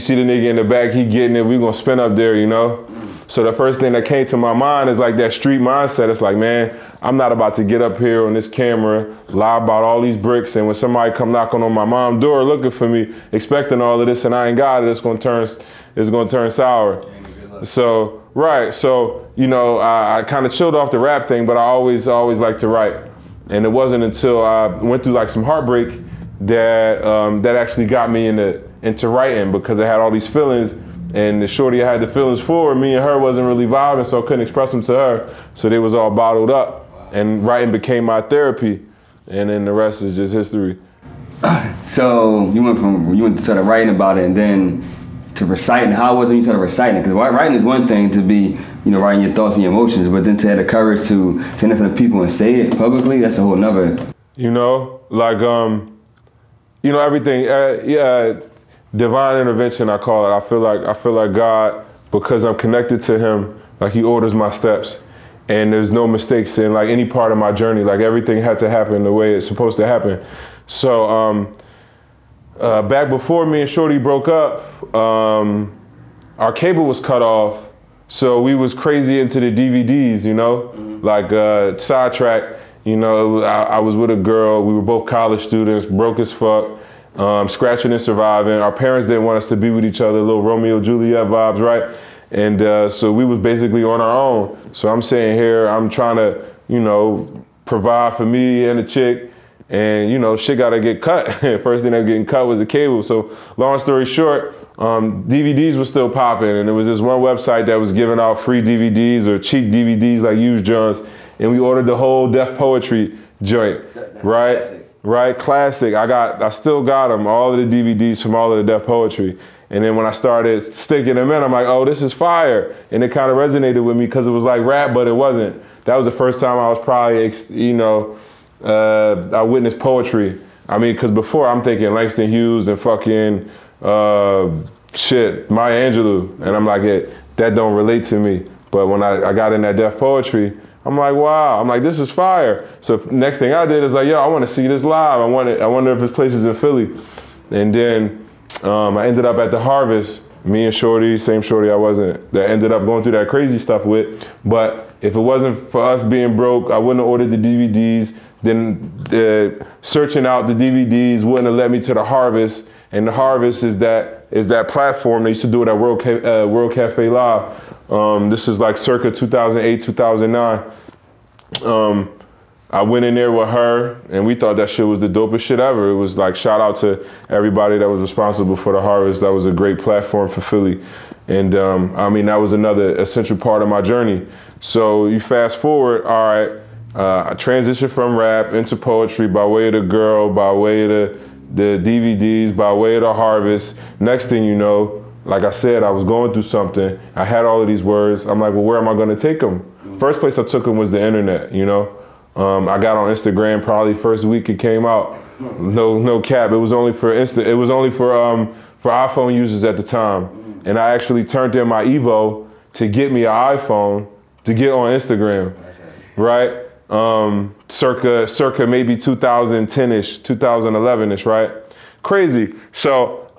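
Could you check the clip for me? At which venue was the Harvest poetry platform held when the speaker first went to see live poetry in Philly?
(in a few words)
World Cafe Live.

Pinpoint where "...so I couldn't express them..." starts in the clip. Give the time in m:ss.
0:34.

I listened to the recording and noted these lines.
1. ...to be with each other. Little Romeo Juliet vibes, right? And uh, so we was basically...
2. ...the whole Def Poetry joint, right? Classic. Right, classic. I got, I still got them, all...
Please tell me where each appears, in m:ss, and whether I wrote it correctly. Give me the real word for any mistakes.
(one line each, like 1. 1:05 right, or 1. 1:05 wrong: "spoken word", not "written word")
1. 1:29 right
2. 1:51 right.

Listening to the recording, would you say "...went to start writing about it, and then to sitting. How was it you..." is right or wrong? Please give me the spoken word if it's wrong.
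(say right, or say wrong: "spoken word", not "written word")
wrong: "reciting", not "sitting".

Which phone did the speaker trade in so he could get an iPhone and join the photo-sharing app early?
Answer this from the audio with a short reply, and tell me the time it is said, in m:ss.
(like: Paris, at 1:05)
Evo, at 3:31.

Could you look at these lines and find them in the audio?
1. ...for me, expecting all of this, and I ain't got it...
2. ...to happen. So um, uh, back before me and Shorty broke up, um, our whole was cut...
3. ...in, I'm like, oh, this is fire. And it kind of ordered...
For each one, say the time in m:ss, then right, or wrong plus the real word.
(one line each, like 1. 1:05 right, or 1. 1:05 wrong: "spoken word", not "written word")
1. 0:12 right
2. 1:09 wrong: "cable", not "whole"
3. 2:01 wrong: "resonated", not "ordered".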